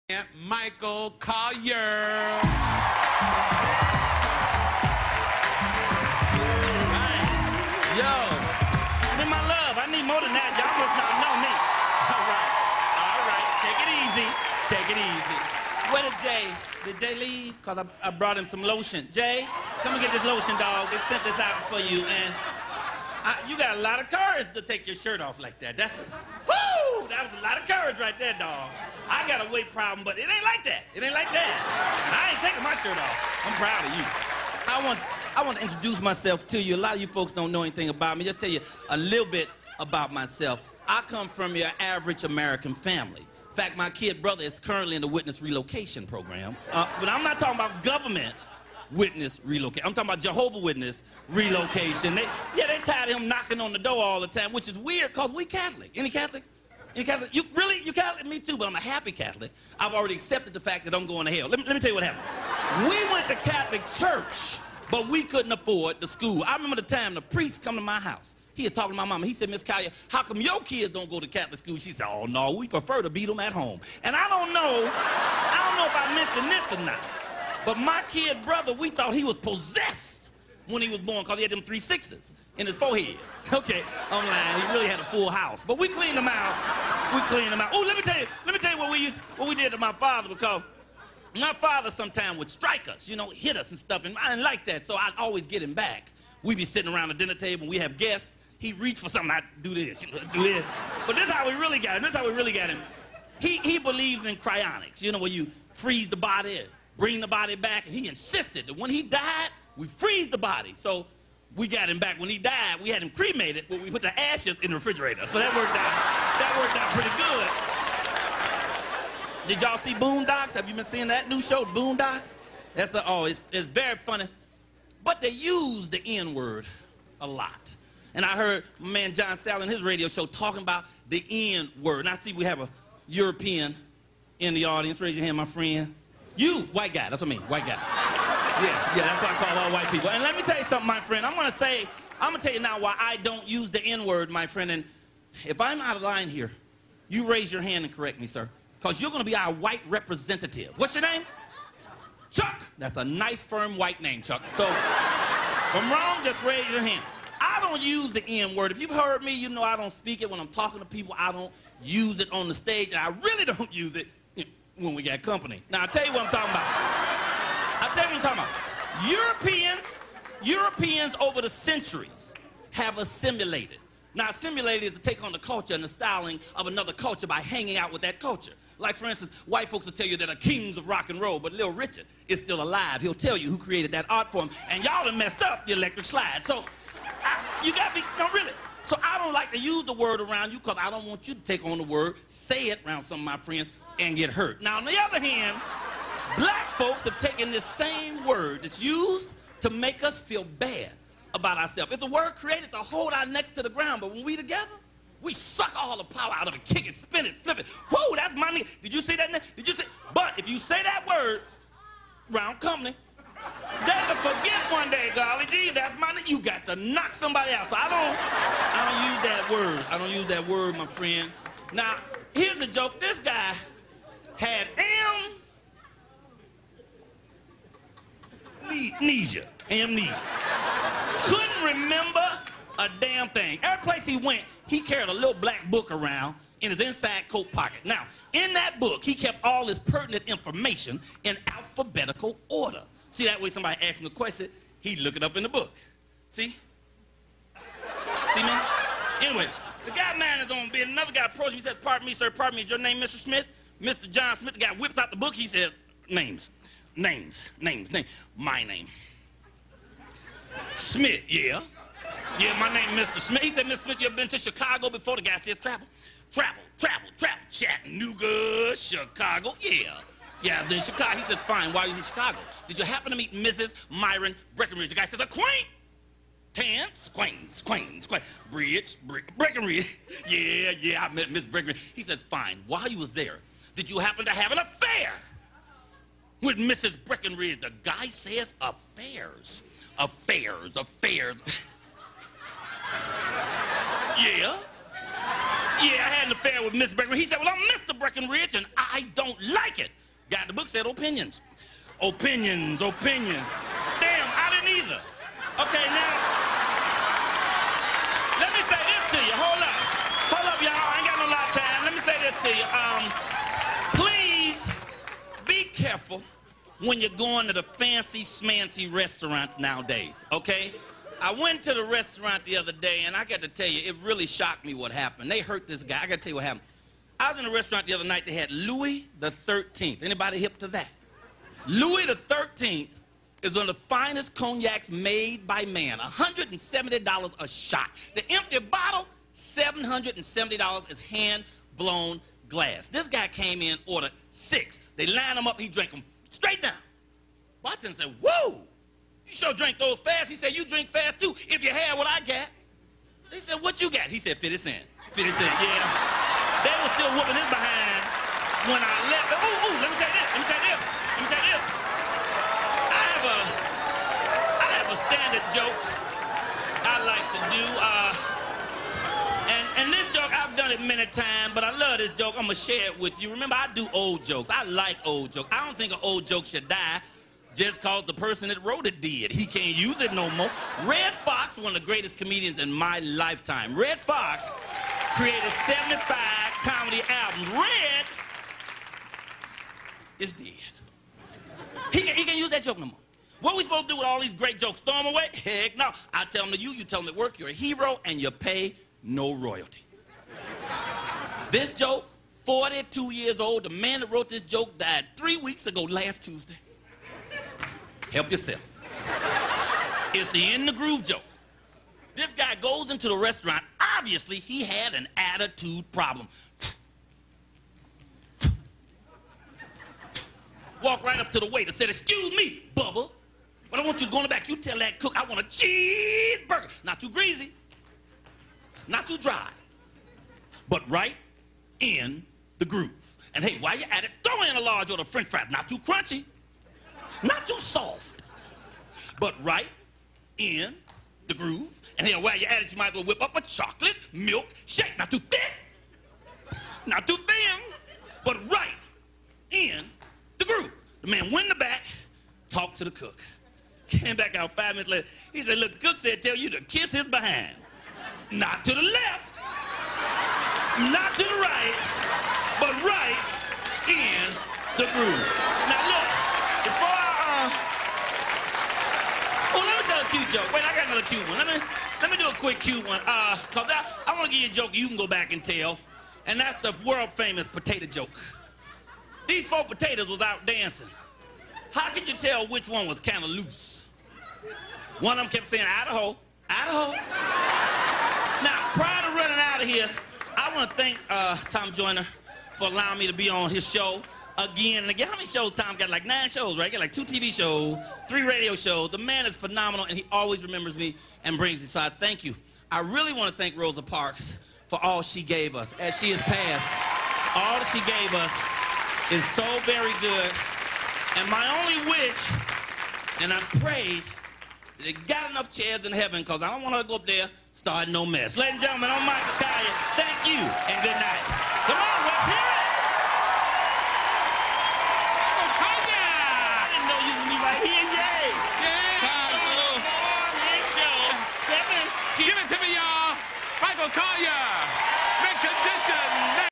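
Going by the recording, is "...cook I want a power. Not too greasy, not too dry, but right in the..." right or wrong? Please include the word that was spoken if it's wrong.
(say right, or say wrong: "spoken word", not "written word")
wrong: "cheeseburger", not "power".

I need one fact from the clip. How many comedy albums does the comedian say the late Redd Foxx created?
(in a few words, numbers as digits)
75.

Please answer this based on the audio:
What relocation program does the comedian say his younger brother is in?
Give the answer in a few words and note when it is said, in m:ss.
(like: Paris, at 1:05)
Jehovah Witness relocation, at 0:50.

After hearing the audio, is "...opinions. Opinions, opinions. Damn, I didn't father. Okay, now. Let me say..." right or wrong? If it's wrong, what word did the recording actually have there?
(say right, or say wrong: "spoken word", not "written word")
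wrong: "either", not "father".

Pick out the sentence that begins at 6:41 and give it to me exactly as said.
This joke, 42 years old, the man that wrote this joke died three weeks ago last Tuesday.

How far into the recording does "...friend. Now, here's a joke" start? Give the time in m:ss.
3:40.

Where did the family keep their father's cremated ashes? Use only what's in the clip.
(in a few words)
refrigerator.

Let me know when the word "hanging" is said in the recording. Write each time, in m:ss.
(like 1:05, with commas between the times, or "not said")
2:57.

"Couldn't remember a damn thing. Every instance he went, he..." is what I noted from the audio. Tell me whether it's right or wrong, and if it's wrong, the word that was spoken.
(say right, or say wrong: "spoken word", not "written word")
wrong: "place", not "instance".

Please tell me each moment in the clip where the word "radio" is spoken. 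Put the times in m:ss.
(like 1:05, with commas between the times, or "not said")
2:09, 8:18.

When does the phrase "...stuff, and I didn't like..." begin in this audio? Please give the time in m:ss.
1:33.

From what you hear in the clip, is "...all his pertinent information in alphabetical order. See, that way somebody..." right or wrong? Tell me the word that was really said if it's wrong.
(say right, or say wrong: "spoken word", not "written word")
right.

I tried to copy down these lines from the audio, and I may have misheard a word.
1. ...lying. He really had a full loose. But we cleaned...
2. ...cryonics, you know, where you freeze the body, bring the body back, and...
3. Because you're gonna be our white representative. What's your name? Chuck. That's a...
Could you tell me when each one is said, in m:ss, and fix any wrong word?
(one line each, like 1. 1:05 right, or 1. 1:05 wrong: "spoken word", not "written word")
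1. 1:24 wrong: "house", not "loose"
2. 1:44 right
3. 2:28 right.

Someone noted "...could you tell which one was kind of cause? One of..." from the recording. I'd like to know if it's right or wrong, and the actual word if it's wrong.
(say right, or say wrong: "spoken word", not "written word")
wrong: "loose", not "cause".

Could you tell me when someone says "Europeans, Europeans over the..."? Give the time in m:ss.
2:49.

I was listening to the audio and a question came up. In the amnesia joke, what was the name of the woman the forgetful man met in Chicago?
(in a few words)
Mrs. Myron Breckenridge.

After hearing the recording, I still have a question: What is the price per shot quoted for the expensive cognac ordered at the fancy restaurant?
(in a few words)
$170.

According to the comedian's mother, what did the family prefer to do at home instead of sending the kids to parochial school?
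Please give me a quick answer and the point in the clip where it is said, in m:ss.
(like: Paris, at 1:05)
beat them, at 1:13.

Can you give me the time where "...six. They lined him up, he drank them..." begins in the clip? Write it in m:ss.
5:44.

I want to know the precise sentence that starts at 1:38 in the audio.
He reached for something, I'd do this, do this.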